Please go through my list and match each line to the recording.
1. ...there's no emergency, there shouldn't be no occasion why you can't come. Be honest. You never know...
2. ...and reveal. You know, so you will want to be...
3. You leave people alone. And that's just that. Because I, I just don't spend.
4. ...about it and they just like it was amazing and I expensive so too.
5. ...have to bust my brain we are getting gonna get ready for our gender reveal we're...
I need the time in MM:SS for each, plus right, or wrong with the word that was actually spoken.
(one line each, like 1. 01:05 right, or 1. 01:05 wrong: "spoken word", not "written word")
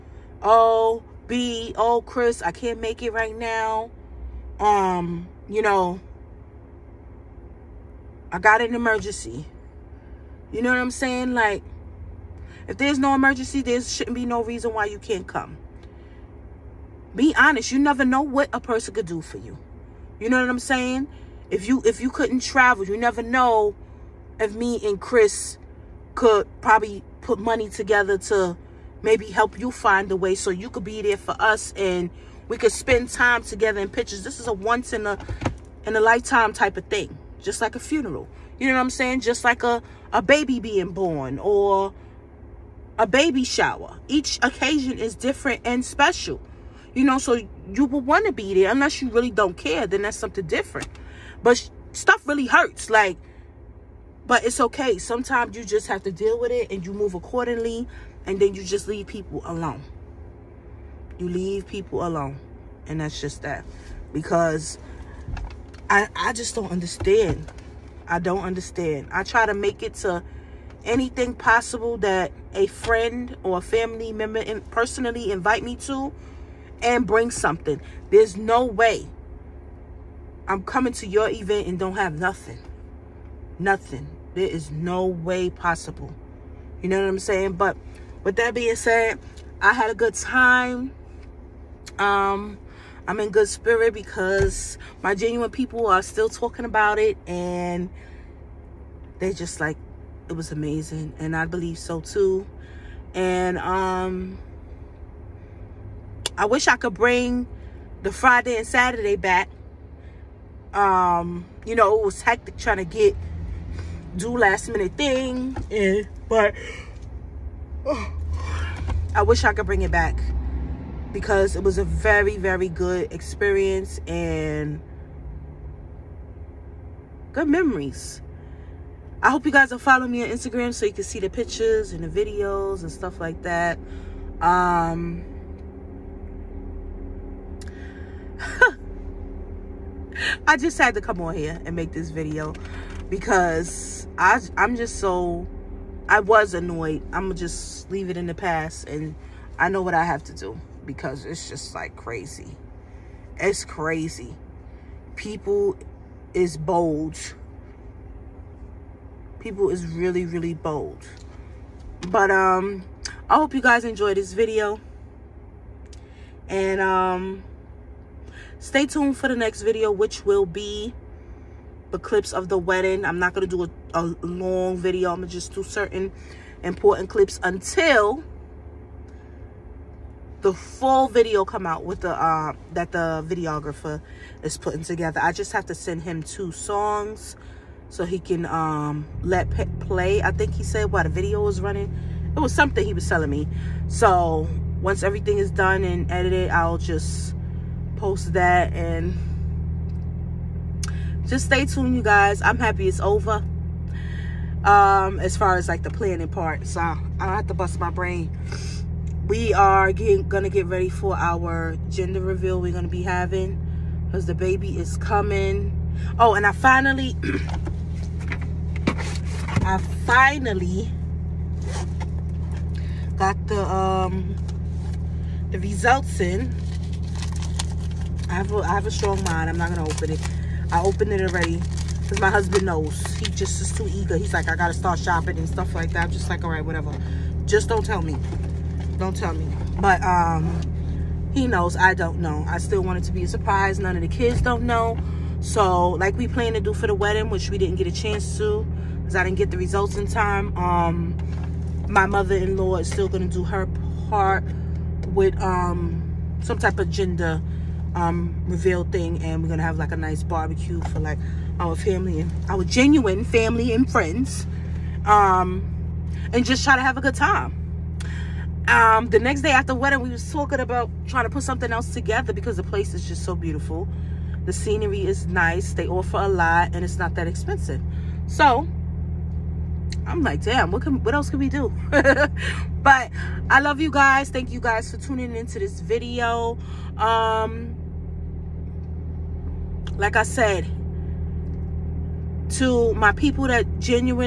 1. 00:12 wrong: "reason", not "occasion"
2. 00:45 wrong: "special", not "reveal"
3. 01:01 wrong: "understand", not "spend"
4. 01:36 wrong: "believe", not "expensive"
5. 03:27 right.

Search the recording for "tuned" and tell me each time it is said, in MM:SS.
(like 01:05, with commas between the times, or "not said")
02:48, 03:21.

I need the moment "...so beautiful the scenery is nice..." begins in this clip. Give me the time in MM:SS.
04:33.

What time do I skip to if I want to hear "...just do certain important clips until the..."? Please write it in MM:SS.
02:55.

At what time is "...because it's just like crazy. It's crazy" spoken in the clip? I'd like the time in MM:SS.
02:30.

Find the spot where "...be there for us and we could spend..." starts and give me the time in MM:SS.
00:30.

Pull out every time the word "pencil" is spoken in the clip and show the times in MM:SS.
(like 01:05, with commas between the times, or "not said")
not said.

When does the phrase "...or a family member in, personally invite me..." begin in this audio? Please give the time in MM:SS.
01:13.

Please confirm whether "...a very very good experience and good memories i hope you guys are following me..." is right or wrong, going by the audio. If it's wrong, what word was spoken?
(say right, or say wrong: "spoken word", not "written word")
right.